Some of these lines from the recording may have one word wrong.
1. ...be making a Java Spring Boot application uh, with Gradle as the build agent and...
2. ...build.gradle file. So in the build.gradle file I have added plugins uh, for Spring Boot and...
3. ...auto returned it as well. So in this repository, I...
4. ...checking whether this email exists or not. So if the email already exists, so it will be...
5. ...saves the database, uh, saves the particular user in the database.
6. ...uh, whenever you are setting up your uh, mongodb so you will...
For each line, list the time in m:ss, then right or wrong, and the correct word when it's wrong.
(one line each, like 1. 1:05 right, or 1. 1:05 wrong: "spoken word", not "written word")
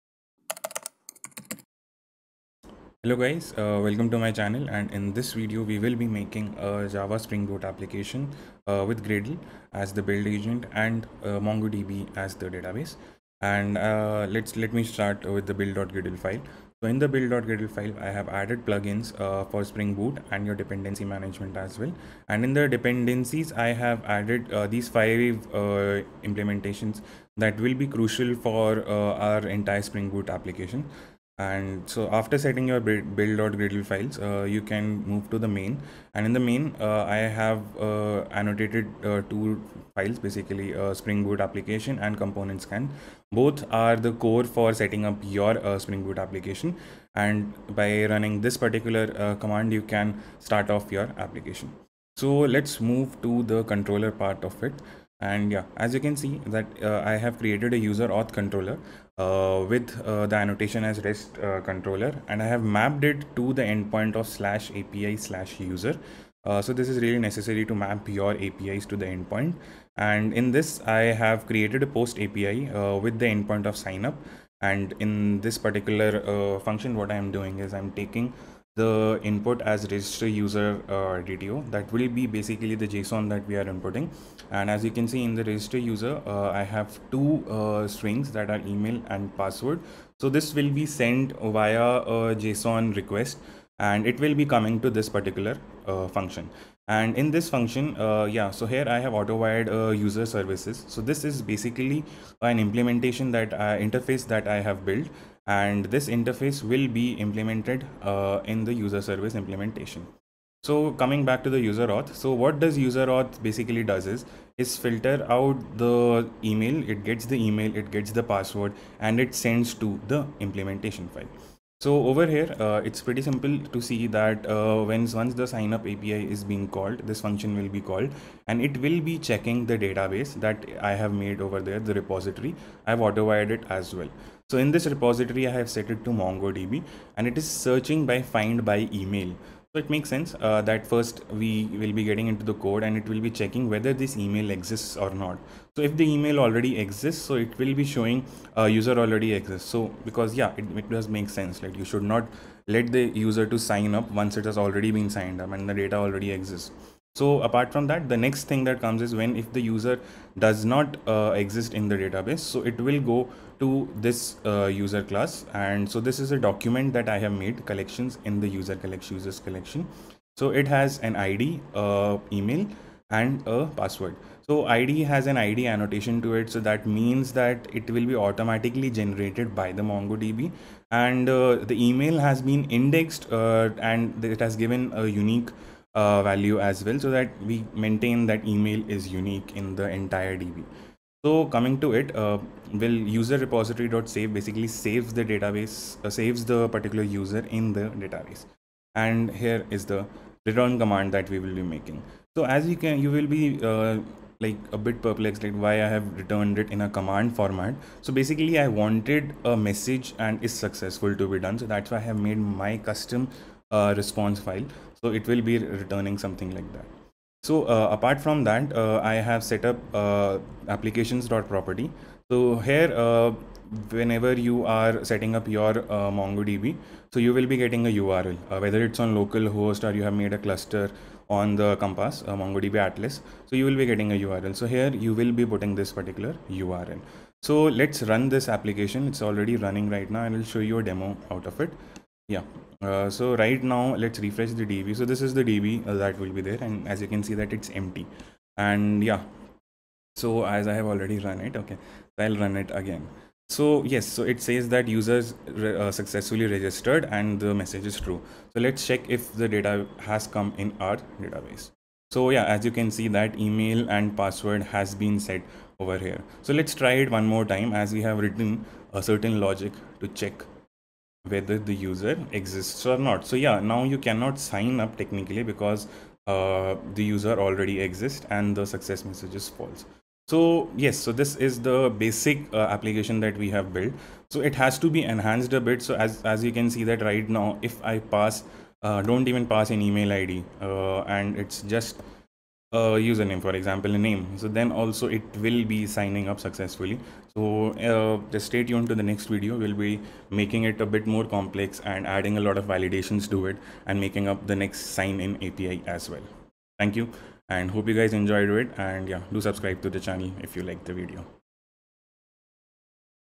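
1. 0:05 right
2. 0:15 right
3. 2:13 wrong: "wired", not "returned"
4. 2:23 right
5. 3:14 right
6. 3:43 right.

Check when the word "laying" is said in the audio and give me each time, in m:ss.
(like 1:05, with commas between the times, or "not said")
not said.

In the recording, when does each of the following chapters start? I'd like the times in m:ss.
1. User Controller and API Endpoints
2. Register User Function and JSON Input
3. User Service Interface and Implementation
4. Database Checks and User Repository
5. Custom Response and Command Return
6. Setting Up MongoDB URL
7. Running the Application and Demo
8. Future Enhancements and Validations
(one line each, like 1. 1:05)
1. 0:49
2. 1:10
3. 1:38
4. 2:09
5. 3:14
6. 3:36
7. 4:00
8. 4:52.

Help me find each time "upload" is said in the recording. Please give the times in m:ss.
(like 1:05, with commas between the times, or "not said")
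not said.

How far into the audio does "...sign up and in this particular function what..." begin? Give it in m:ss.
1:13.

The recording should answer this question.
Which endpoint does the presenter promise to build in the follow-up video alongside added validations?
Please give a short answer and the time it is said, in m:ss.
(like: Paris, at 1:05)
sign in API, at 5:04.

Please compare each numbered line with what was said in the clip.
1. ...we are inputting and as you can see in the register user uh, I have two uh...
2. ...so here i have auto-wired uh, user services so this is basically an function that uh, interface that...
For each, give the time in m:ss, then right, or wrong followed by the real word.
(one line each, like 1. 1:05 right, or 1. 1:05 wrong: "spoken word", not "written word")
1. 1:23 right
2. 1:38 wrong: "implementation", not "function".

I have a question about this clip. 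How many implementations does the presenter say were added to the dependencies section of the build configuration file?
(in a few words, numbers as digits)
5.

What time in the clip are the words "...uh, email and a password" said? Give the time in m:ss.
2:51.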